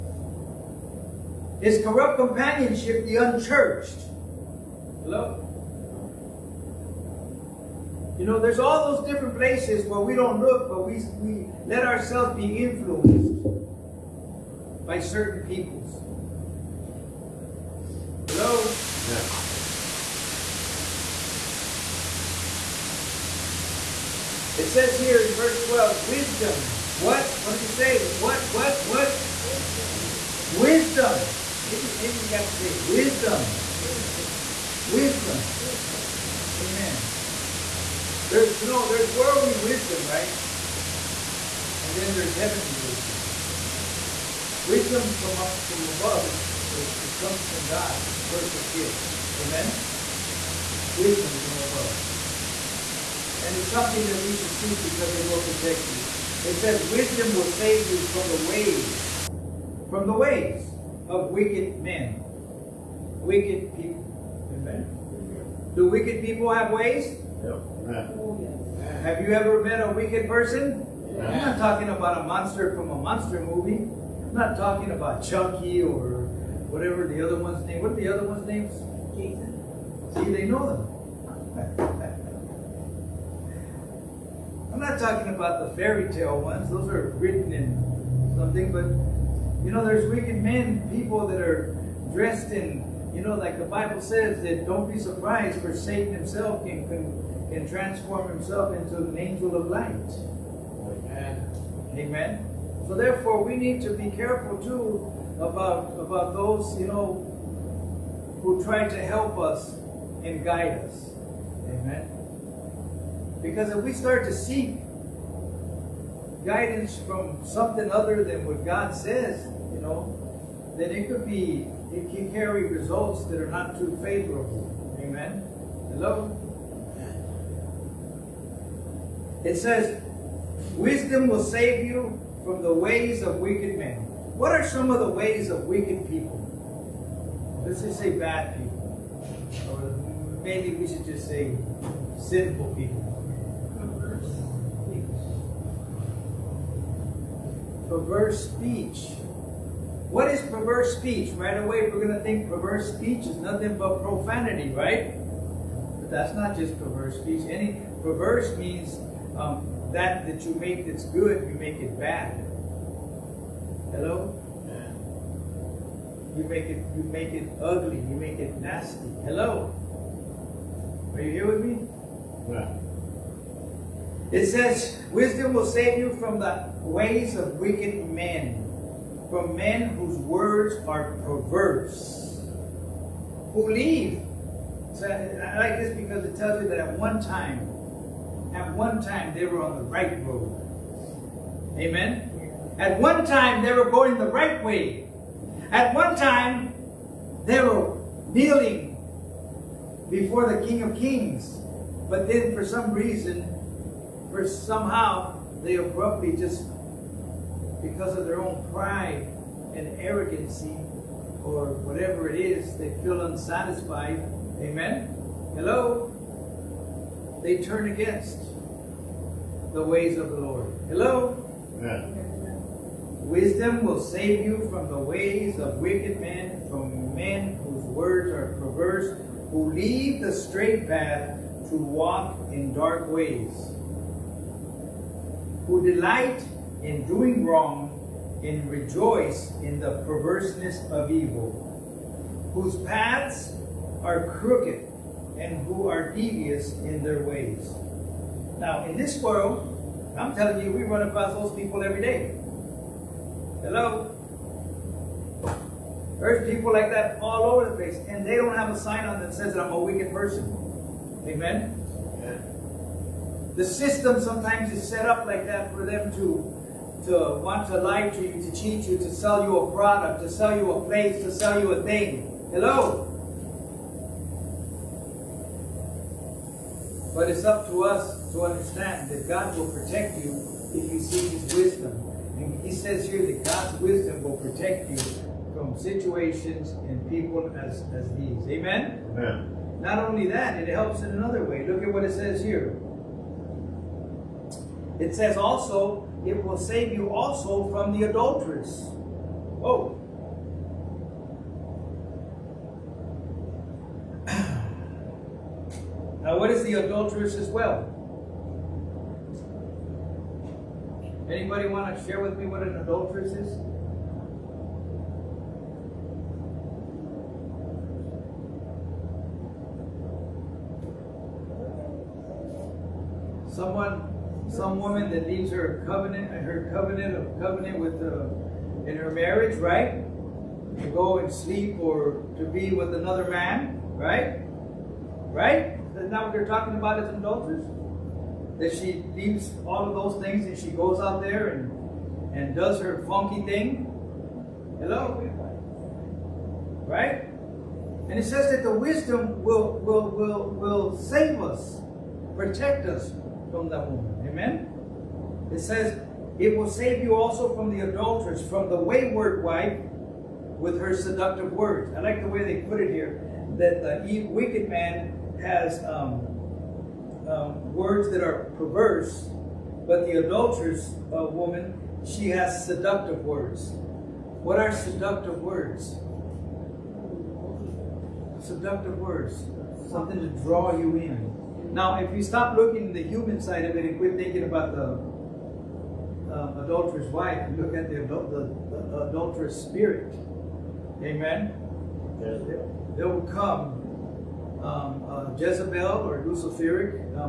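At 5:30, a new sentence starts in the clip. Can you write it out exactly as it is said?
To go and sleep or to be with another man, right?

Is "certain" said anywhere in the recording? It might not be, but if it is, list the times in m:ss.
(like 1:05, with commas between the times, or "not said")
0:14.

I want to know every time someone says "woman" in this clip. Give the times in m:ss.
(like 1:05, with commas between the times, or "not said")
5:24, 5:53, 6:11.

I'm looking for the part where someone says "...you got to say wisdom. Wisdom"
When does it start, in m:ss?
0:32.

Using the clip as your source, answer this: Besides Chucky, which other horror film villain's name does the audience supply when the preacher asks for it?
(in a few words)
Jason.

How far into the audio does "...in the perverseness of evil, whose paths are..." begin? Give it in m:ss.
3:59.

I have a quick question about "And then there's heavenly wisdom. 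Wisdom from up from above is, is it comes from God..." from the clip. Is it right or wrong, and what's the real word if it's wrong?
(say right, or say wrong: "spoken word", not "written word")
right.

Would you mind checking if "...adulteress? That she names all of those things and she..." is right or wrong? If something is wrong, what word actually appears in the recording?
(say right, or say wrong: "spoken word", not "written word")
wrong: "leaves", not "names".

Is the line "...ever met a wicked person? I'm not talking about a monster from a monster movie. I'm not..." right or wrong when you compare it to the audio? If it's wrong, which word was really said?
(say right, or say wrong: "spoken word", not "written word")
right.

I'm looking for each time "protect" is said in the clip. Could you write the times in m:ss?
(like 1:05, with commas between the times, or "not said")
0:55, 4:39, 4:44, 5:52.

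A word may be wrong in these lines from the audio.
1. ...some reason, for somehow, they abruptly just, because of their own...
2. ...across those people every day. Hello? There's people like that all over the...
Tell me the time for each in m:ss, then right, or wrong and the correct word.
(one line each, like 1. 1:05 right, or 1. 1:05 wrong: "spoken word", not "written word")
1. 3:22 right
2. 4:11 right.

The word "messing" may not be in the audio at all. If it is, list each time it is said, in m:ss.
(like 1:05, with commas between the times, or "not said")
not said.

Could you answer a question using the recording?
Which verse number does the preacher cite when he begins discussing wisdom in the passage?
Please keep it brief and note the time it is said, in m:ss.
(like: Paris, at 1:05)
12, at 0:25.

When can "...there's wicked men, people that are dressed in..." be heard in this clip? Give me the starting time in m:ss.
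1:29.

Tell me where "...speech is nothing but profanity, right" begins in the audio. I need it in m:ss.
2:32.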